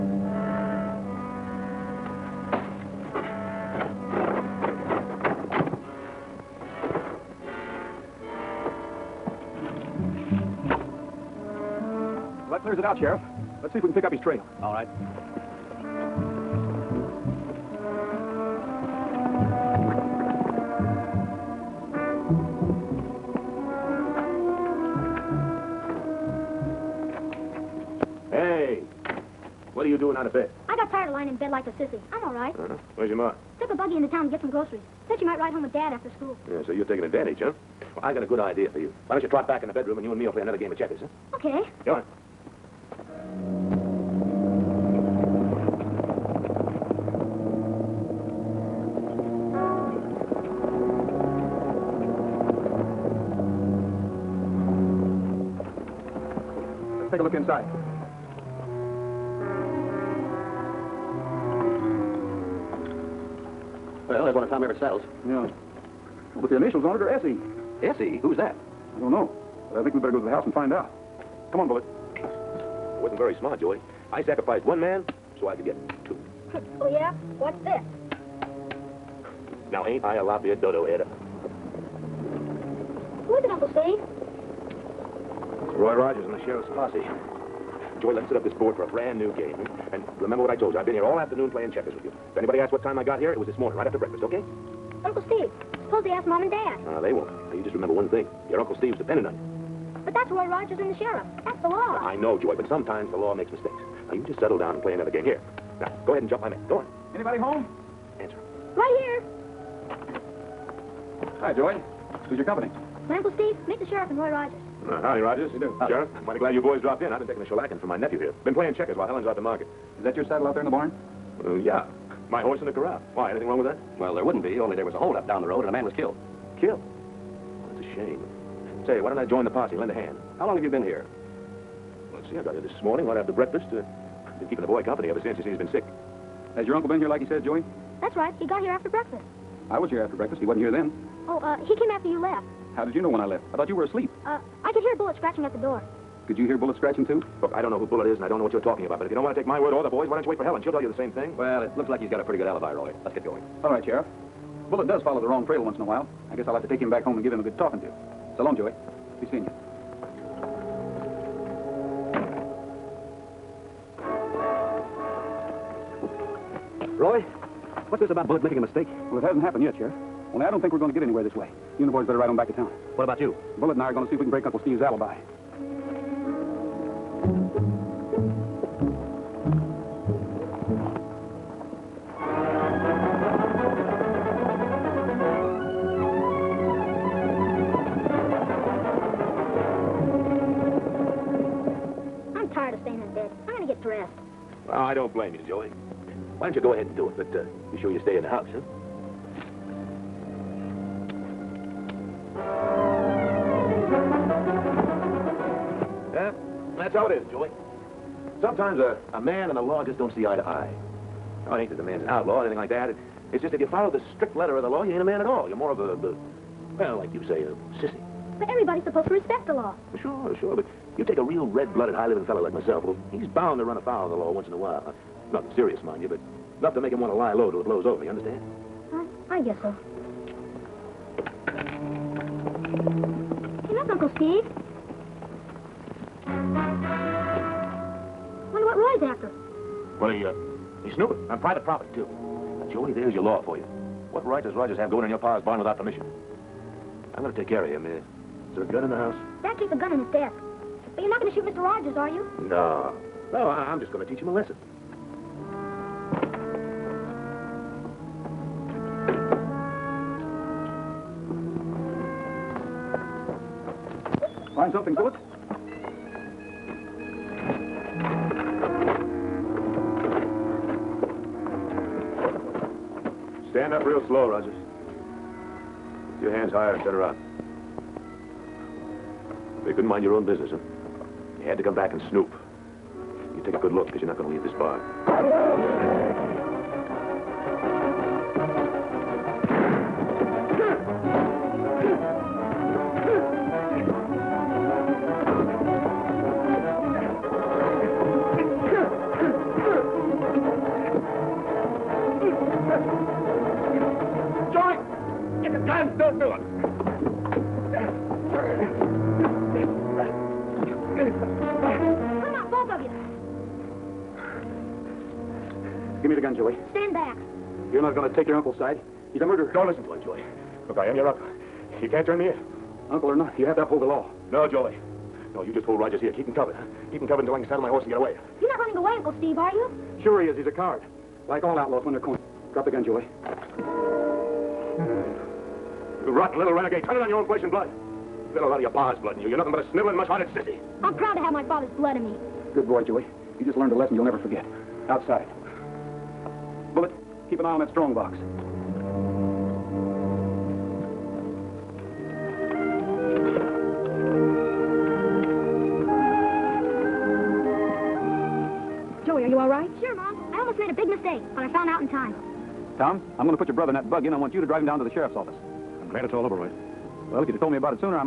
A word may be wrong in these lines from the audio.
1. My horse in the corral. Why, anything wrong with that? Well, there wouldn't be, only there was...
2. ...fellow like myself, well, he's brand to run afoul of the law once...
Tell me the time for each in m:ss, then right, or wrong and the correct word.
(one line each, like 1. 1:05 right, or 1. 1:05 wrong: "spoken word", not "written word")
1. 2:02 right
2. 3:42 wrong: "bound", not "brand".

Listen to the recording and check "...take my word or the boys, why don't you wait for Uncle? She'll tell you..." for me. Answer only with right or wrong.
wrong.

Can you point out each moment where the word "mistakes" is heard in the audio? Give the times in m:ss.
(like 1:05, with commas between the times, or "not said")
1:43, 2:48.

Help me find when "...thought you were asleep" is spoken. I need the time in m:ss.
2:23.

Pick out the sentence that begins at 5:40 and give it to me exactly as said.
I'm proud to have my father's blood in me.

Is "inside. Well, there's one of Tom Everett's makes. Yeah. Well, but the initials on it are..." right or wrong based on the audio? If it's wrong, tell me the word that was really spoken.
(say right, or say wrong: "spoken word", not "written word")
wrong: "saddles", not "makes".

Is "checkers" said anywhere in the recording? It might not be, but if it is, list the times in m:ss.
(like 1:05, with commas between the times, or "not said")
0:40, 1:31, 1:58.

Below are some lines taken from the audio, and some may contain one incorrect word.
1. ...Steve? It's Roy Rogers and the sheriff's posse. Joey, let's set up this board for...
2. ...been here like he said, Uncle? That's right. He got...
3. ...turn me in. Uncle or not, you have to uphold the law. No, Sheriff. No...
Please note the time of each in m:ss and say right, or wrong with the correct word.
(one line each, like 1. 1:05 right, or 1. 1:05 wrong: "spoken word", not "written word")
1. 1:23 right
2. 2:16 wrong: "Joey", not "Uncle"
3. 5:22 wrong: "Joey", not "Sheriff".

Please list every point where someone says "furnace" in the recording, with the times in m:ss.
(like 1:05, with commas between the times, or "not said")
not said.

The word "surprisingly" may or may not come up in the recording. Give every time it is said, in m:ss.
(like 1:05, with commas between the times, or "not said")
not said.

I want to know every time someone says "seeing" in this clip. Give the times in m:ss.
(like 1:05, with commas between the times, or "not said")
2:39.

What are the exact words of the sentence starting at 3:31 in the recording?
Oh, it ain't that the man's an outlaw or anything like that.